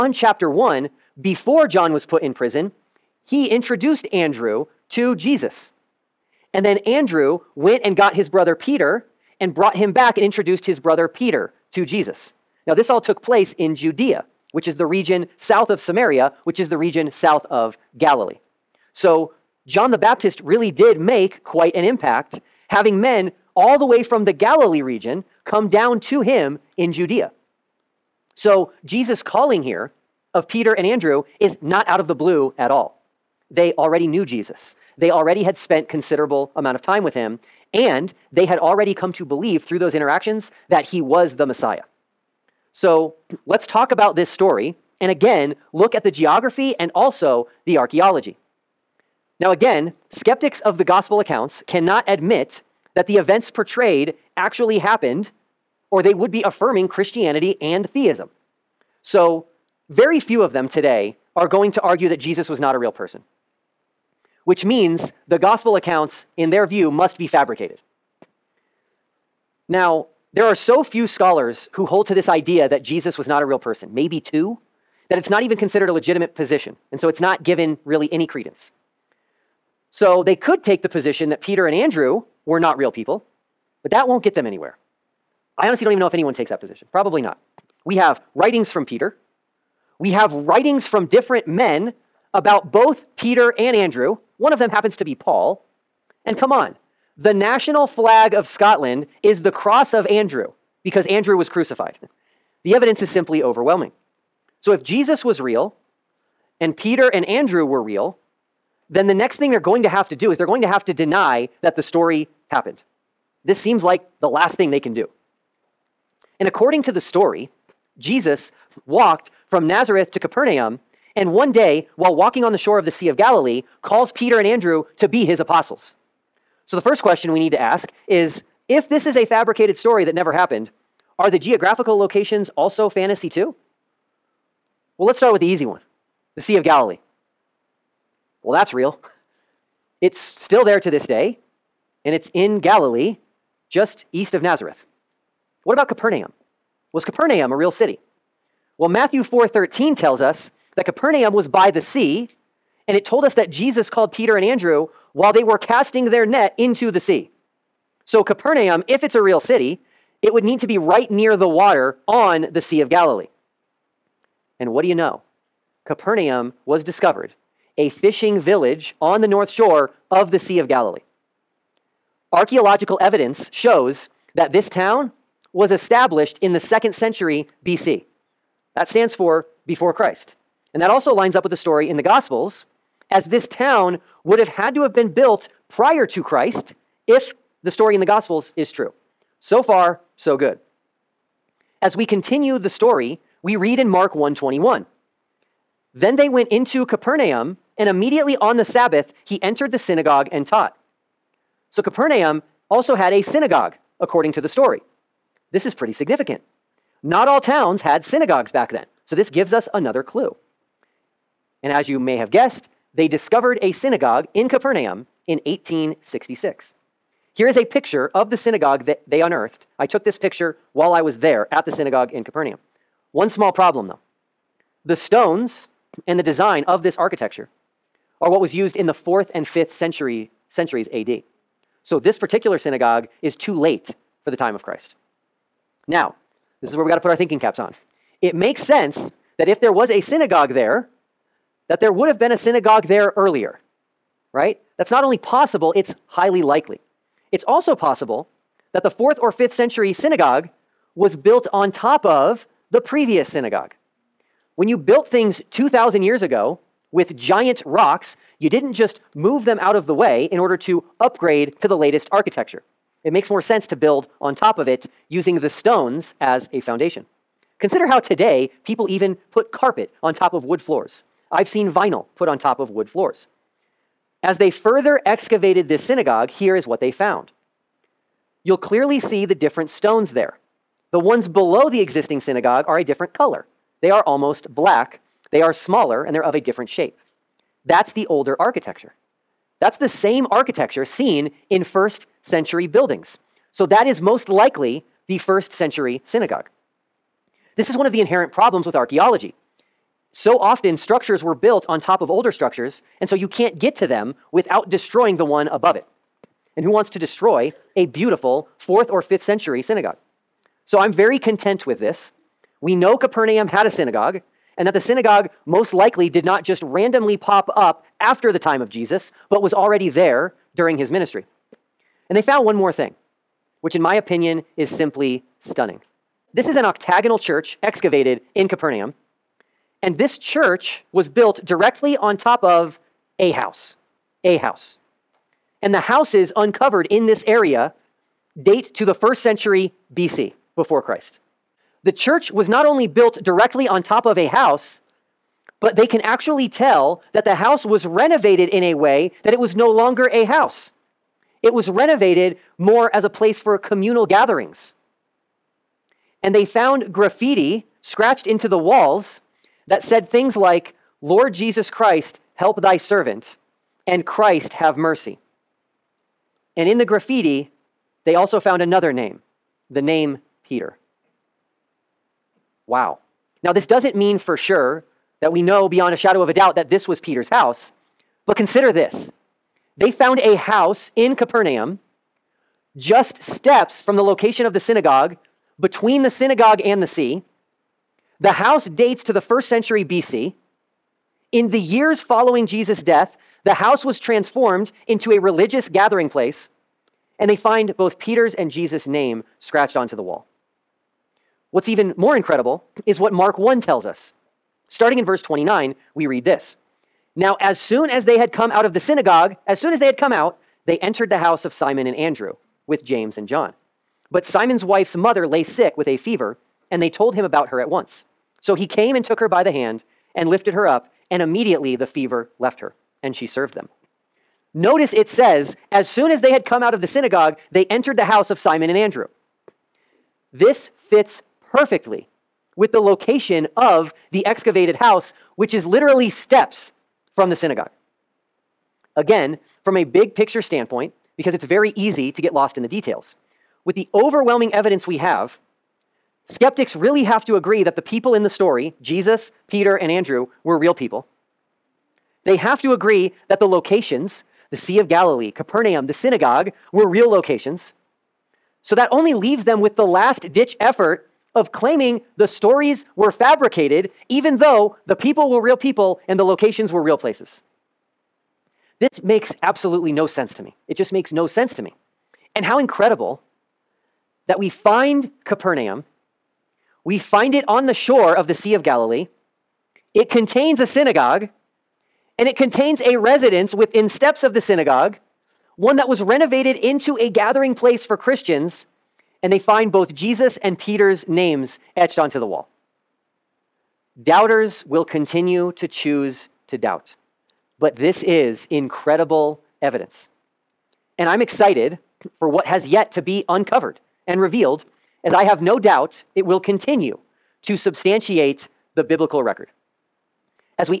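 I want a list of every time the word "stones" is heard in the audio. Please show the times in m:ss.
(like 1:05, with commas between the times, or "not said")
3:44, 4:25, 4:39.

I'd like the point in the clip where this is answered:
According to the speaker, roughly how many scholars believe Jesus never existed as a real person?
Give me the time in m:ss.
1:13.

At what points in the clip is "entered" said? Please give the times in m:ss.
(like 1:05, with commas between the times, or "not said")
3:19, 6:50, 7:07.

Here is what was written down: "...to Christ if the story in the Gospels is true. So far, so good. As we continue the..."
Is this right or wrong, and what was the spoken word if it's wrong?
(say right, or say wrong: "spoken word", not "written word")
right.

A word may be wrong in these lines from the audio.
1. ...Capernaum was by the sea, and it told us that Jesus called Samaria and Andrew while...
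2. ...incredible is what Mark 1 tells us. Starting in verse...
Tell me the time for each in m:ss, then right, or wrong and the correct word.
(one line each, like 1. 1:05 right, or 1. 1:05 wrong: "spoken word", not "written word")
1. 2:30 wrong: "Peter", not "Samaria"
2. 6:42 right.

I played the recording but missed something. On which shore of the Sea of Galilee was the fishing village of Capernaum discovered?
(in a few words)
north shore.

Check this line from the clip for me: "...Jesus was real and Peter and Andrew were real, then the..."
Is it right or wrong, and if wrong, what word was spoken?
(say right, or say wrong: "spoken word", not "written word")
right.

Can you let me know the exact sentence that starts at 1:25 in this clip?
I honestly don't even know if anyone takes that position.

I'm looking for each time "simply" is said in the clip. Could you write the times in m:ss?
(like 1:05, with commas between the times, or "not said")
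1:43, 5:24.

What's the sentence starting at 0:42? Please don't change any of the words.
So let's talk about this story and again look at the geography and also the archaeology.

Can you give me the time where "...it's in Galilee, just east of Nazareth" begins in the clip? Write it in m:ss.
2:22.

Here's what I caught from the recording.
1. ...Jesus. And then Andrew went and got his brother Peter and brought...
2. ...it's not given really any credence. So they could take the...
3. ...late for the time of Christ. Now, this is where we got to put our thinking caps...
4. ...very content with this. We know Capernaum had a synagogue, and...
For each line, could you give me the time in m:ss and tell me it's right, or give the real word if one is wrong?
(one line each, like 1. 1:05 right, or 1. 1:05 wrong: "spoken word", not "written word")
1. 0:05 right
2. 1:17 right
3. 3:53 right
4. 5:10 right.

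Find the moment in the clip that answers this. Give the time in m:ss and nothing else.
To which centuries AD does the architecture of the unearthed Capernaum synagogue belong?
3:48.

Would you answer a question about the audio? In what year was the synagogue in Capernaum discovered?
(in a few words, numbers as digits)
1866.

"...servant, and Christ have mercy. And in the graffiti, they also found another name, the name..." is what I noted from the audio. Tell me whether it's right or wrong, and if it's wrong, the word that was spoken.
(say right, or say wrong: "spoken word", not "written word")
right.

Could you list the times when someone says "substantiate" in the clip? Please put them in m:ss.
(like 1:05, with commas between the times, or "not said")
8:27.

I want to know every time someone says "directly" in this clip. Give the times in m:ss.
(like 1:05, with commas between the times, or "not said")
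5:31, 5:43.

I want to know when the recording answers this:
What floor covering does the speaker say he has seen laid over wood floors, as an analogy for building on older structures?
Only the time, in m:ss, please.
4:31.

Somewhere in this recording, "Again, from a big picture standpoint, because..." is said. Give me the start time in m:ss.
7:18.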